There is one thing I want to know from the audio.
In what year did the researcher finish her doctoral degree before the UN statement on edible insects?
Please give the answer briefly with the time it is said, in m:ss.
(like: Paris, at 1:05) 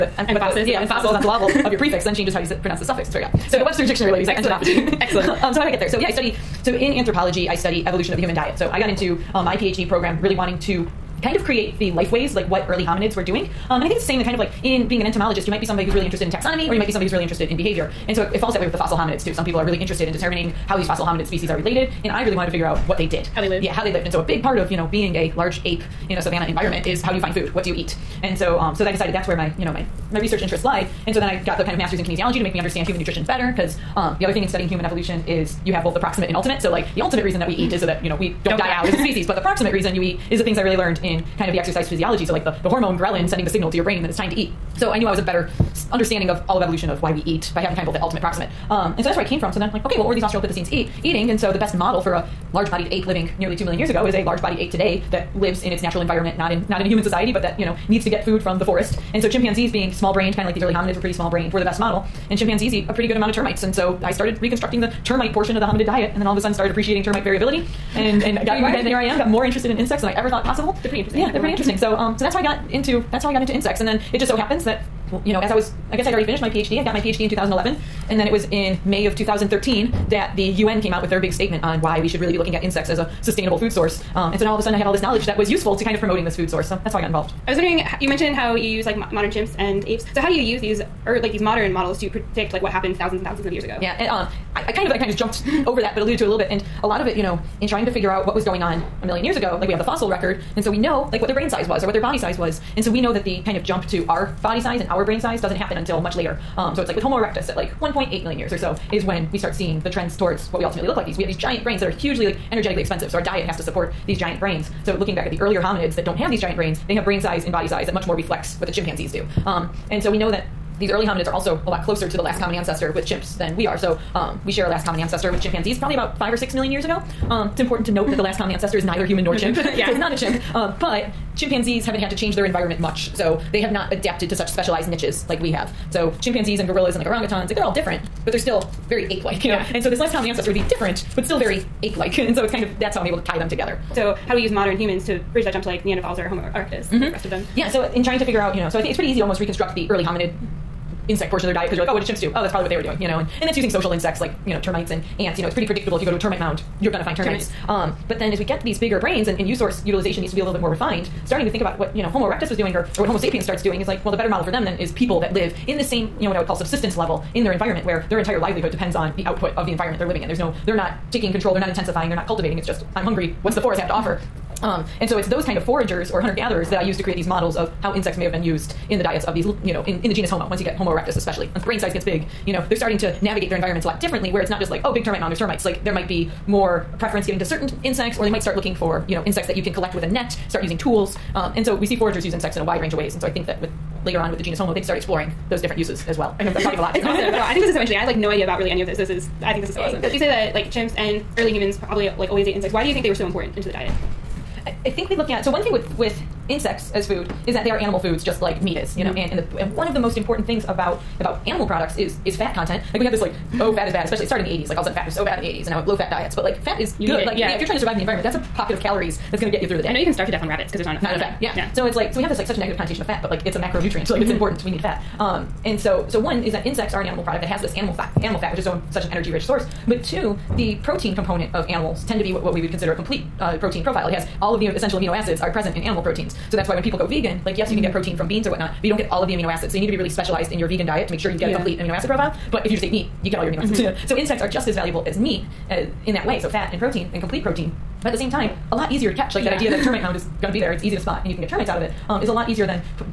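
2011, at 1:17.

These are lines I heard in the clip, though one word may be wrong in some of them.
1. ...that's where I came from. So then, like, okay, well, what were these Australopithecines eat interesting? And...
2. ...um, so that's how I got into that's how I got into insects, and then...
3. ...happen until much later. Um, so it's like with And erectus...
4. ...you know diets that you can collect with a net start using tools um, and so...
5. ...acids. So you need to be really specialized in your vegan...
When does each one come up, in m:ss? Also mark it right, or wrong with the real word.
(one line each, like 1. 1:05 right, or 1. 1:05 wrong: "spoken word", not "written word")
1. 0:49 wrong: "eating", not "interesting"
2. 1:11 right
3. 1:45 wrong: "Homo", not "And"
4. 3:09 wrong: "insects", not "diets"
5. 3:59 right.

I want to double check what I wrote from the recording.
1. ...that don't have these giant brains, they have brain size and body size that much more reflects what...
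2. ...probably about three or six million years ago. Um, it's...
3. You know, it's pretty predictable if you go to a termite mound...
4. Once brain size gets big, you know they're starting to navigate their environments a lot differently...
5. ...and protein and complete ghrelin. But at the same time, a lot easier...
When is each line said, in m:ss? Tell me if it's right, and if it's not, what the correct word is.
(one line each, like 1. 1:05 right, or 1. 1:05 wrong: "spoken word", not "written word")
1. 1:55 right
2. 2:05 wrong: "five", not "three"
3. 2:35 right
4. 3:01 right
5. 4:06 wrong: "protein", not "ghrelin".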